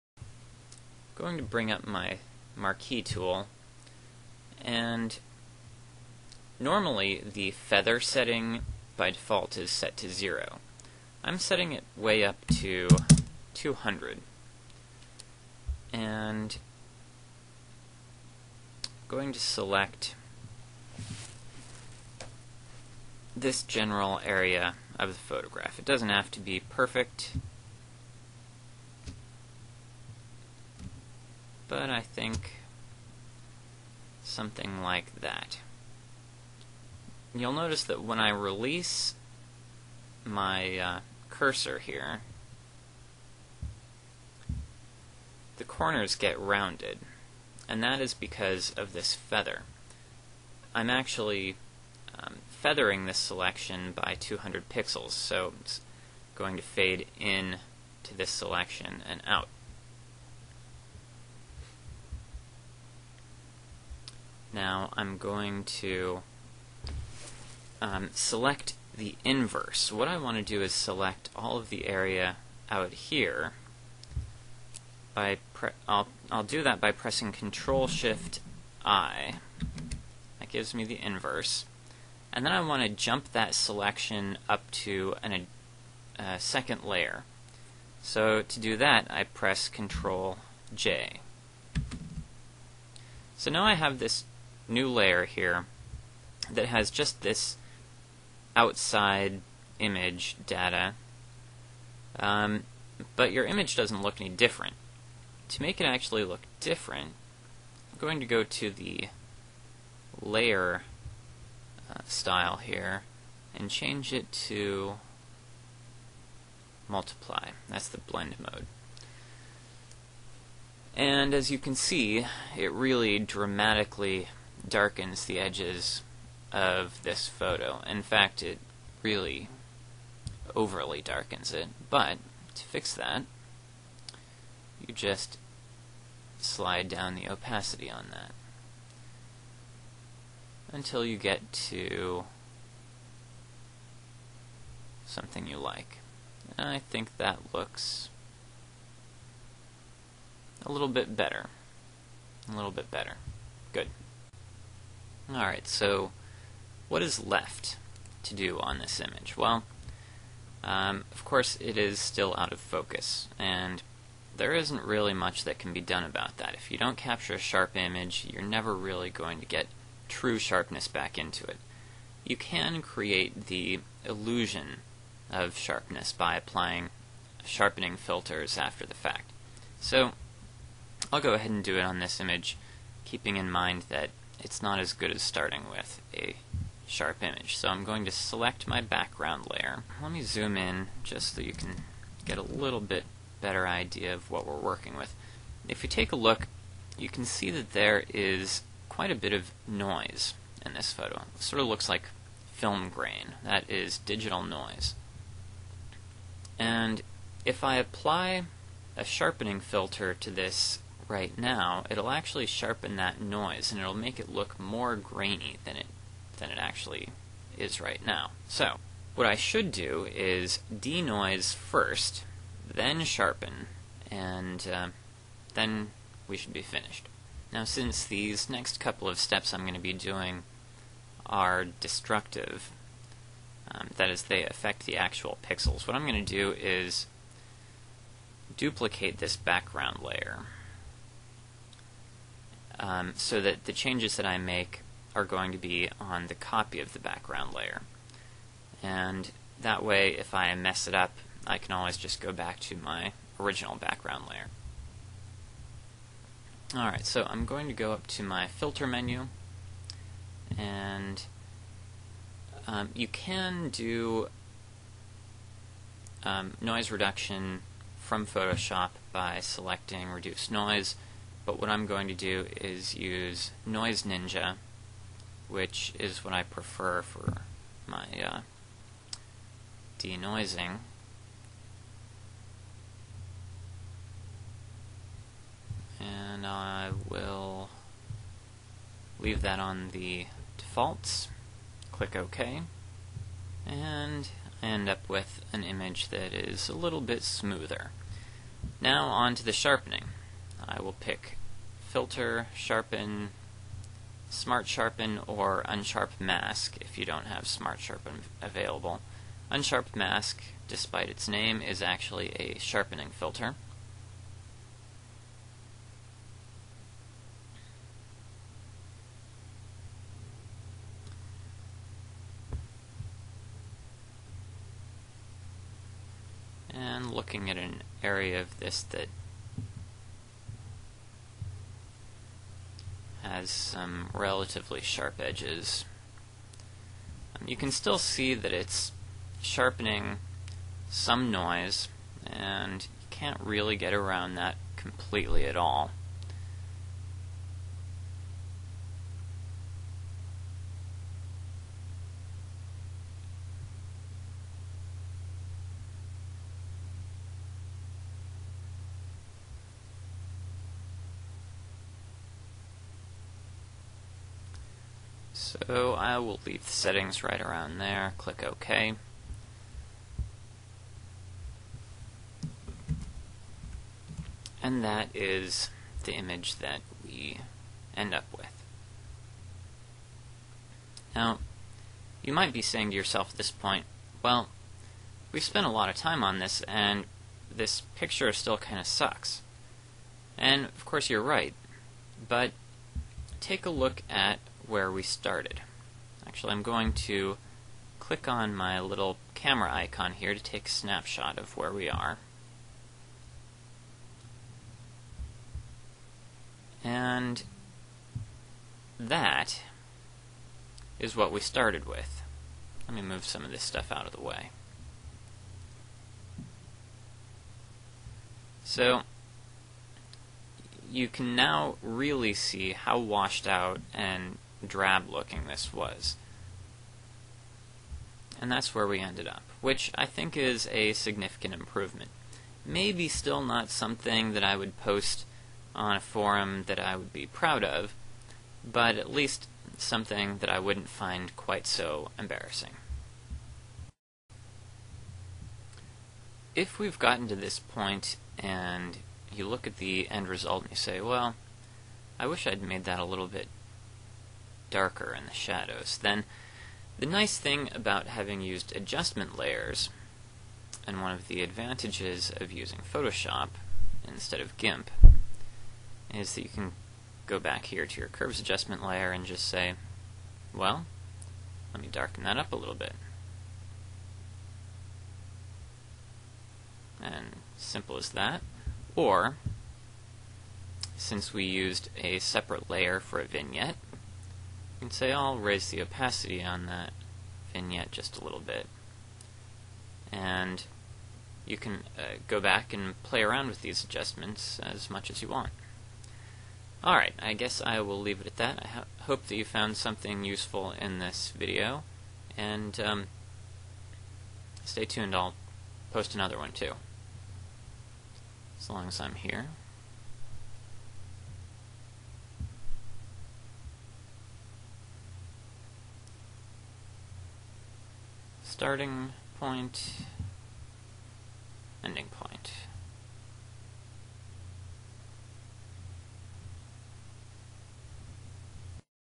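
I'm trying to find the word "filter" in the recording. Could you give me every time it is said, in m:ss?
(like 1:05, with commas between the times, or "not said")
2:57, 3:29, 4:18, 5:01, 5:13.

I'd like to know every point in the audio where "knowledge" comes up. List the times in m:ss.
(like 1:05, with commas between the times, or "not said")
not said.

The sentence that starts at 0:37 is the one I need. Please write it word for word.
You'll notice that when I release my uh, cursor here, the corners get rounded, and that is because of this feather.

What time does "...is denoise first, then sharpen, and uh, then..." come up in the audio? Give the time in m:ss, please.
3:40.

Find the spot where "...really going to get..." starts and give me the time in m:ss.
2:48.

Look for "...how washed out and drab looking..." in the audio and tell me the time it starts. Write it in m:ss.
7:02.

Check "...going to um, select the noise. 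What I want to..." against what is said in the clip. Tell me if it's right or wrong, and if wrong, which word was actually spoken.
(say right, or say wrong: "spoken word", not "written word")
wrong: "inverse", not "noise".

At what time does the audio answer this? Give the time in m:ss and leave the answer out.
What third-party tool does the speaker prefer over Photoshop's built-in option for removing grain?
4:33.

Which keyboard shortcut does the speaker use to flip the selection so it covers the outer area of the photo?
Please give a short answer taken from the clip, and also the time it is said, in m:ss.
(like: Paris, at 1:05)
Control Shift I, at 1:17.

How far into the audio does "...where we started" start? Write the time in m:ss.
6:34.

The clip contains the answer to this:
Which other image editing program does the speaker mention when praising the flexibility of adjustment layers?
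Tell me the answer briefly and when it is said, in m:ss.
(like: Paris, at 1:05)
GIMP, at 7:44.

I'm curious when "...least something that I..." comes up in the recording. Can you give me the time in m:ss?
7:19.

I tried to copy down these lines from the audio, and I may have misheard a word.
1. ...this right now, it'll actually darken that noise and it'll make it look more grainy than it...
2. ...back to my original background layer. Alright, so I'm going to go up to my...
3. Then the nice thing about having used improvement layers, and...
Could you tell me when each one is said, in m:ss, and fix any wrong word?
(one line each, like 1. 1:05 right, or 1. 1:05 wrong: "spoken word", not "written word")
1. 3:30 wrong: "sharpen", not "darken"
2. 4:12 right
3. 7:36 wrong: "adjustment", not "improvement".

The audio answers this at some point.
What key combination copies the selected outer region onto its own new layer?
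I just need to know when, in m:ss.
1:29.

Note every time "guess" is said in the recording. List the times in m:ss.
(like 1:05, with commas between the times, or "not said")
8:17.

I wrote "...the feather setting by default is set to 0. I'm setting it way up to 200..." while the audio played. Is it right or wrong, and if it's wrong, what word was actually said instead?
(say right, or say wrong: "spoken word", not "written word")
right.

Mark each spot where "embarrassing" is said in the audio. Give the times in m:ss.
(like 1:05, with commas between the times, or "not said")
7:22.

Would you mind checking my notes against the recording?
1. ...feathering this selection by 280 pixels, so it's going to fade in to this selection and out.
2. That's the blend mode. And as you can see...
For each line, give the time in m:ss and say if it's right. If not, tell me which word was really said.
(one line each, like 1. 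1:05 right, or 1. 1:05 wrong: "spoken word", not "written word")
1. 0:52 wrong: "200", not "280"
2. 1:57 right.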